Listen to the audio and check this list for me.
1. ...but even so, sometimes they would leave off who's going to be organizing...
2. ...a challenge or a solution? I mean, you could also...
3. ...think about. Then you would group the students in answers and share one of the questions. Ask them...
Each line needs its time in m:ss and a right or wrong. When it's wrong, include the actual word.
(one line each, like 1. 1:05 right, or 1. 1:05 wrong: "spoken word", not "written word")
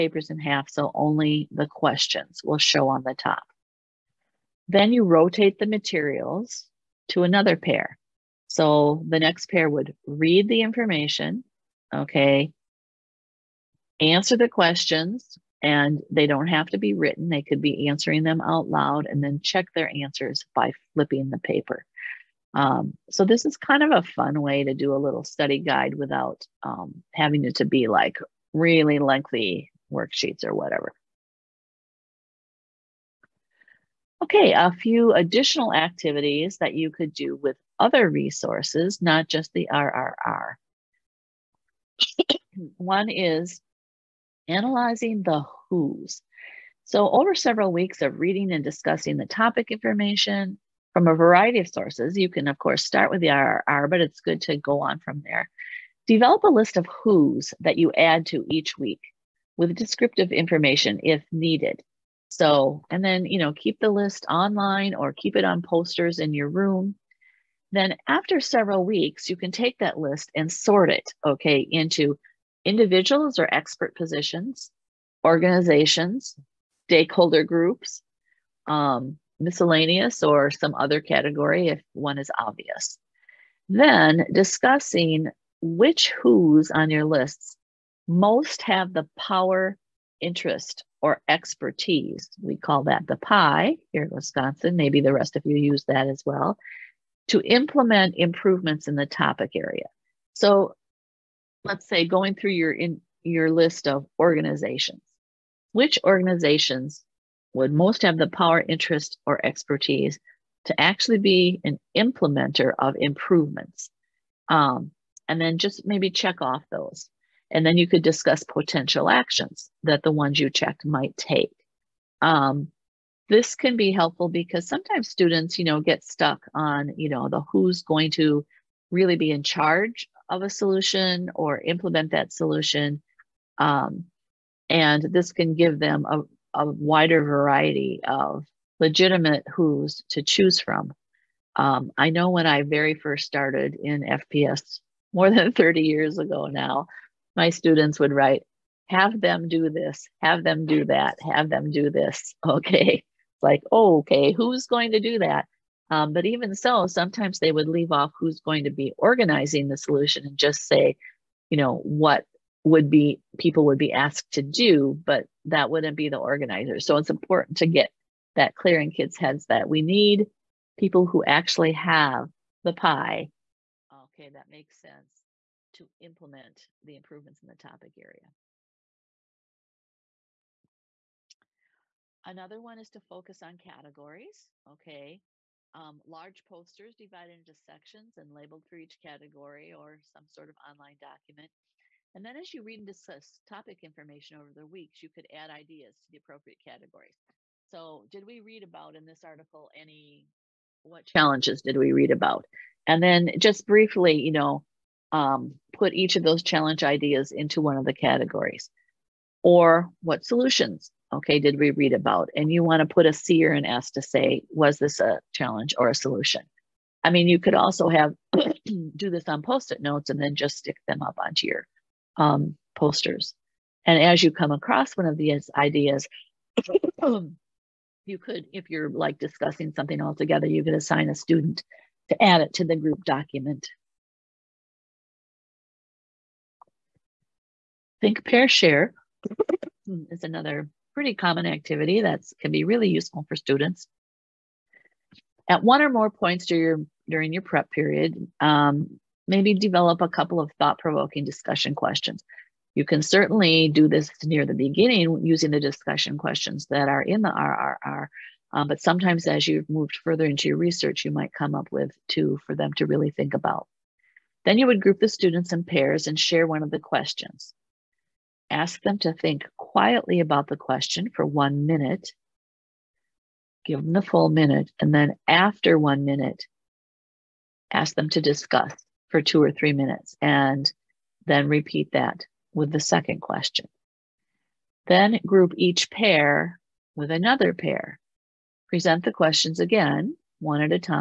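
1. 2:36 right
2. 3:35 right
3. 4:23 wrong: "pairs", not "answers".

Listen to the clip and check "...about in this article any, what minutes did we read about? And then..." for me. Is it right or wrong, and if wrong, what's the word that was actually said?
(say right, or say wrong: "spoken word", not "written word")
wrong: "challenges", not "minutes".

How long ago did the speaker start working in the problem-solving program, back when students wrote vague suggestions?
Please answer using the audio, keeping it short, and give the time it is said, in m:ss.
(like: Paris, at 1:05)
more than 30, at 2:25.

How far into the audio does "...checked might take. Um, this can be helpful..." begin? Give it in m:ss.
2:00.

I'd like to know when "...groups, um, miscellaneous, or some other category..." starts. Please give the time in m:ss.
1:17.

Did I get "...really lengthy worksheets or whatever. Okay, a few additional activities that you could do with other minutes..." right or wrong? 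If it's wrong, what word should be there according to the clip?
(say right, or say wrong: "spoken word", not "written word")
wrong: "resources", not "minutes".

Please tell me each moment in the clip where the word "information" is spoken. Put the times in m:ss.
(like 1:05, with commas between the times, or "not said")
0:10, 0:49, 1:00, 3:13.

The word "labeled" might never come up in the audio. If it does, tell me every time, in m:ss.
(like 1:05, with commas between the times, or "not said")
3:08.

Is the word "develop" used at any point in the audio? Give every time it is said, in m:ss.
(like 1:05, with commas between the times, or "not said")
0:56, 4:09.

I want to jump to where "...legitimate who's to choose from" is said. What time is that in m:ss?
2:18.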